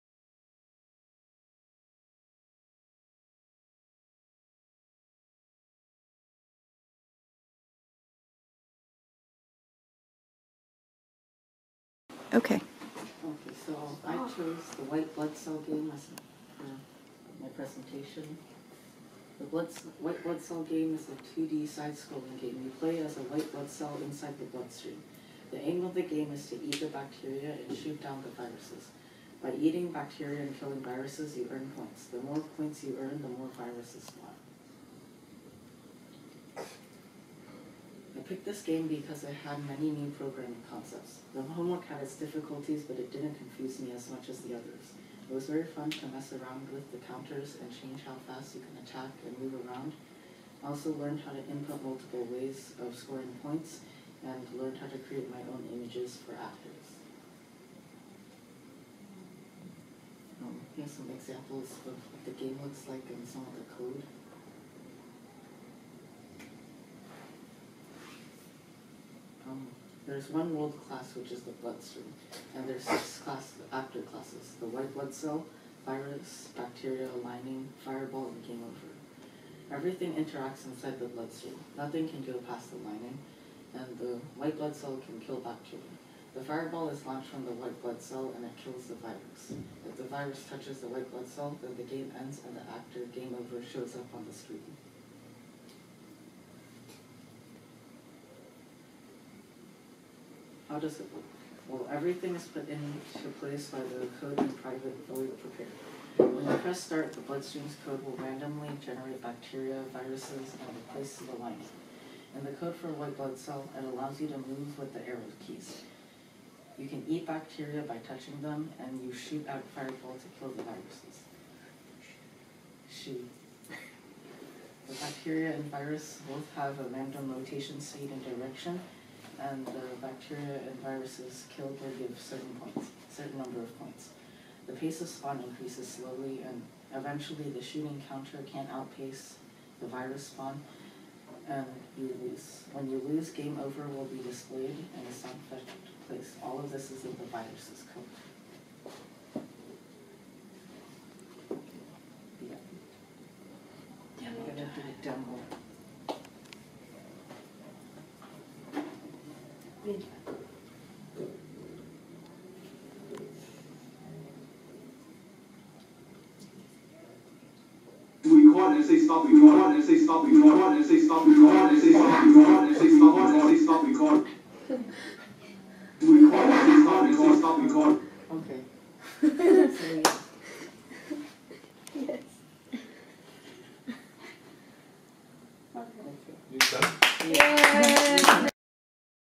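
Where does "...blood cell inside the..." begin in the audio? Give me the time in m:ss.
0:23.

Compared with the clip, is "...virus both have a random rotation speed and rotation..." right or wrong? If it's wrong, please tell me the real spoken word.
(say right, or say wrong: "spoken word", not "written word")
wrong: "direction", not "rotation".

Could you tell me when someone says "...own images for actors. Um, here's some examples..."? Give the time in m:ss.
0:55.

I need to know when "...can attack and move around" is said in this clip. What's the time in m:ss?
0:48.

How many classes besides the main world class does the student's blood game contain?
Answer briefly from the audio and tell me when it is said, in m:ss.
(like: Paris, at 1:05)
6, at 1:12.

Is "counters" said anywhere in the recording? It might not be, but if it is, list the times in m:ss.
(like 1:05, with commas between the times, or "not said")
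0:47, 2:18.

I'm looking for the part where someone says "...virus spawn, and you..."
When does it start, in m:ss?
2:19.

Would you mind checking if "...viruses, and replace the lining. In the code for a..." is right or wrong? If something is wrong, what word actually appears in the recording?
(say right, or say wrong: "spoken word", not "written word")
right.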